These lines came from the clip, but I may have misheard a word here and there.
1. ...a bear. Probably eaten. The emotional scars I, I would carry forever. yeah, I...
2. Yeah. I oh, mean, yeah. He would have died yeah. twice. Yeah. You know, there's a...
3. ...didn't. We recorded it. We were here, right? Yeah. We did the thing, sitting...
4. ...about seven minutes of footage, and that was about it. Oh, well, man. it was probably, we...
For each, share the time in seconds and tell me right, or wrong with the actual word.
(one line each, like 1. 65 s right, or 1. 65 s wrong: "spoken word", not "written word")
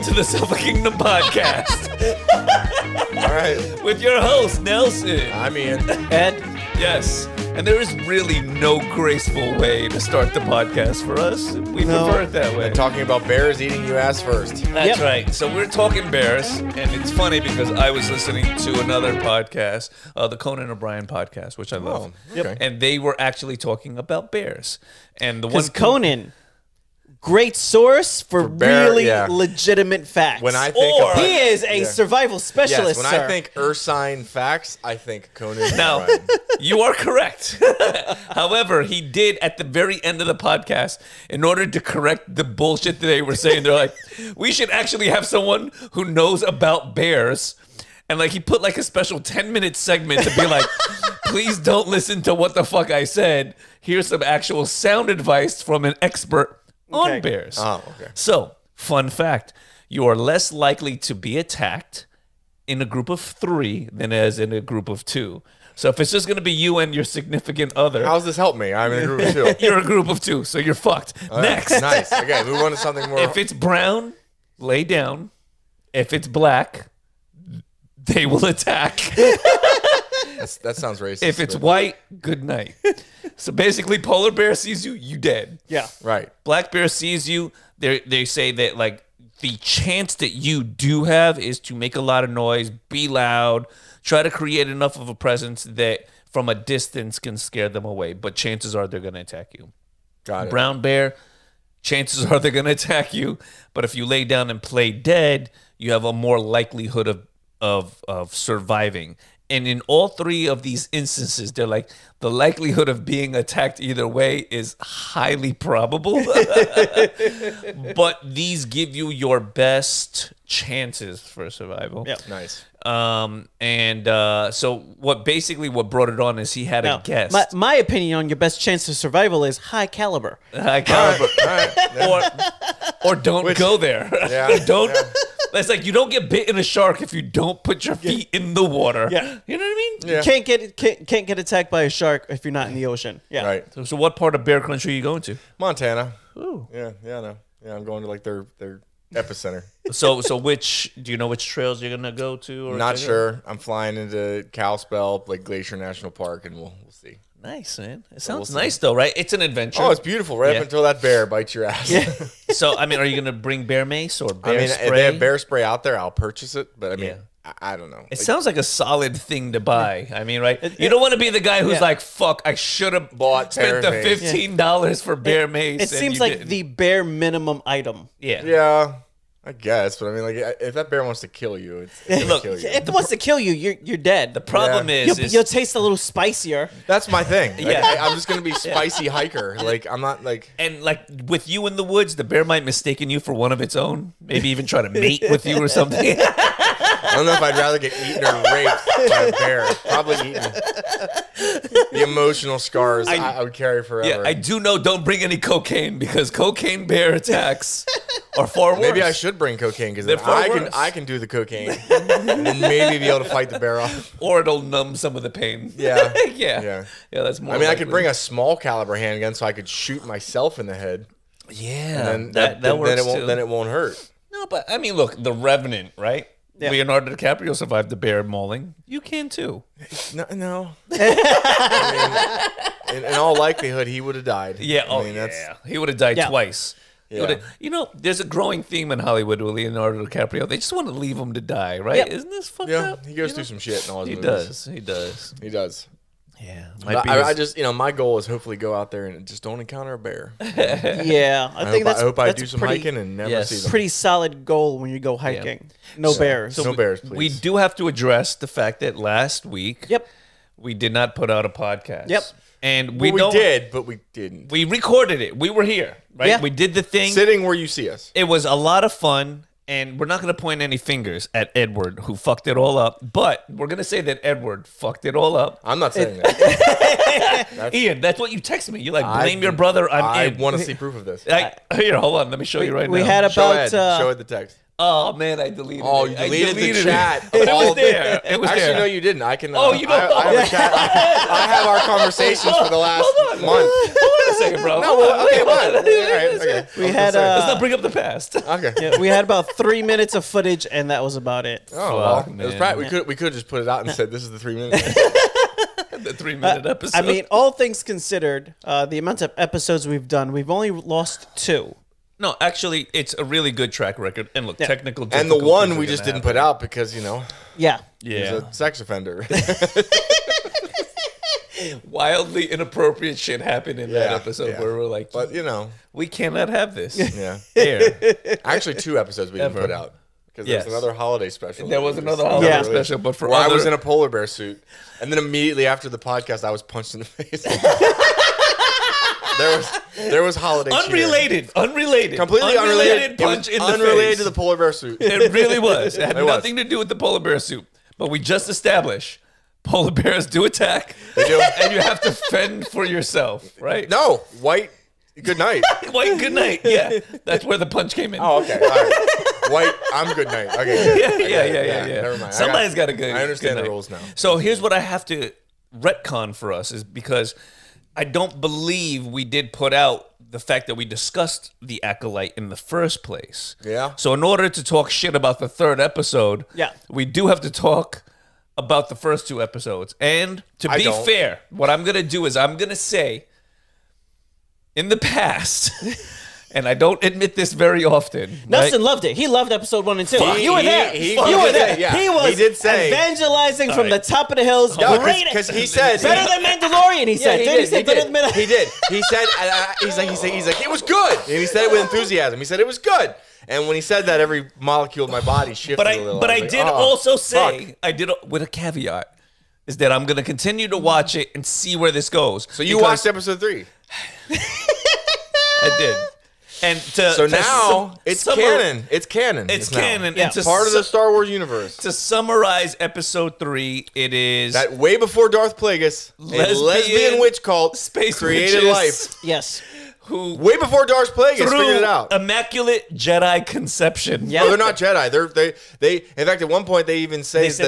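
1. 199 s right
2. 234 s right
3. 264 s right
4. 299 s wrong: "three", not "seven".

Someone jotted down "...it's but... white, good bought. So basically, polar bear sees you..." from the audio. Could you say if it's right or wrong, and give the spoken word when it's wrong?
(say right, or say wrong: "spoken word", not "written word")
wrong: "night", not "bought".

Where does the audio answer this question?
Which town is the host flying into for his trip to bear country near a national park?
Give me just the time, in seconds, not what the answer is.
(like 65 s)
154 s.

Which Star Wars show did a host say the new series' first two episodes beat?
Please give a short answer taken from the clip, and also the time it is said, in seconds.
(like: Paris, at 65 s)
Mandalorian, at 396 s.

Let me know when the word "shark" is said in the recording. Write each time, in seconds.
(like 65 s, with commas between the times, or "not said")
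136 s, 141 s.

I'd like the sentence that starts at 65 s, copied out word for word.
So if it's just gonna be you and your significant other, how's this help me?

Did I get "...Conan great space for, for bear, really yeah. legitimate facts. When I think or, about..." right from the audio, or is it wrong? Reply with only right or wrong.
wrong.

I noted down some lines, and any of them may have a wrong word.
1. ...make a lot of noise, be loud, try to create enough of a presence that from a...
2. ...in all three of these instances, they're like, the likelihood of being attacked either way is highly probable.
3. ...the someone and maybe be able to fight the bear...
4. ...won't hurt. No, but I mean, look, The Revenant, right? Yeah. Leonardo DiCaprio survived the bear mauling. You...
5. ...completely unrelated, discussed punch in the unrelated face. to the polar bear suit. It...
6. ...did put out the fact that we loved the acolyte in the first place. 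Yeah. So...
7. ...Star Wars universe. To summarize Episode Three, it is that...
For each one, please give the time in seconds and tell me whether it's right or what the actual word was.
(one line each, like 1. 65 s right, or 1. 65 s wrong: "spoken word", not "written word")
1. 91 s right
2. 109 s right
3. 211 s wrong: "cocaine", not "someone"
4. 223 s right
5. 342 s wrong: "unrelated", not "discussed"
6. 369 s wrong: "discussed", not "loved"
7. 420 s right.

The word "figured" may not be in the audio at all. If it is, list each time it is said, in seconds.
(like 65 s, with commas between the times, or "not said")
431 s.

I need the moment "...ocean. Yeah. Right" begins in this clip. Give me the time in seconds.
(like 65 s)
142 s.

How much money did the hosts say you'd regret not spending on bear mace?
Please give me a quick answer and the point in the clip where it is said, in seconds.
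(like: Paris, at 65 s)
$15, at 173 s.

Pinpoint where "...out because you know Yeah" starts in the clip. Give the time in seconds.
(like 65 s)
316 s.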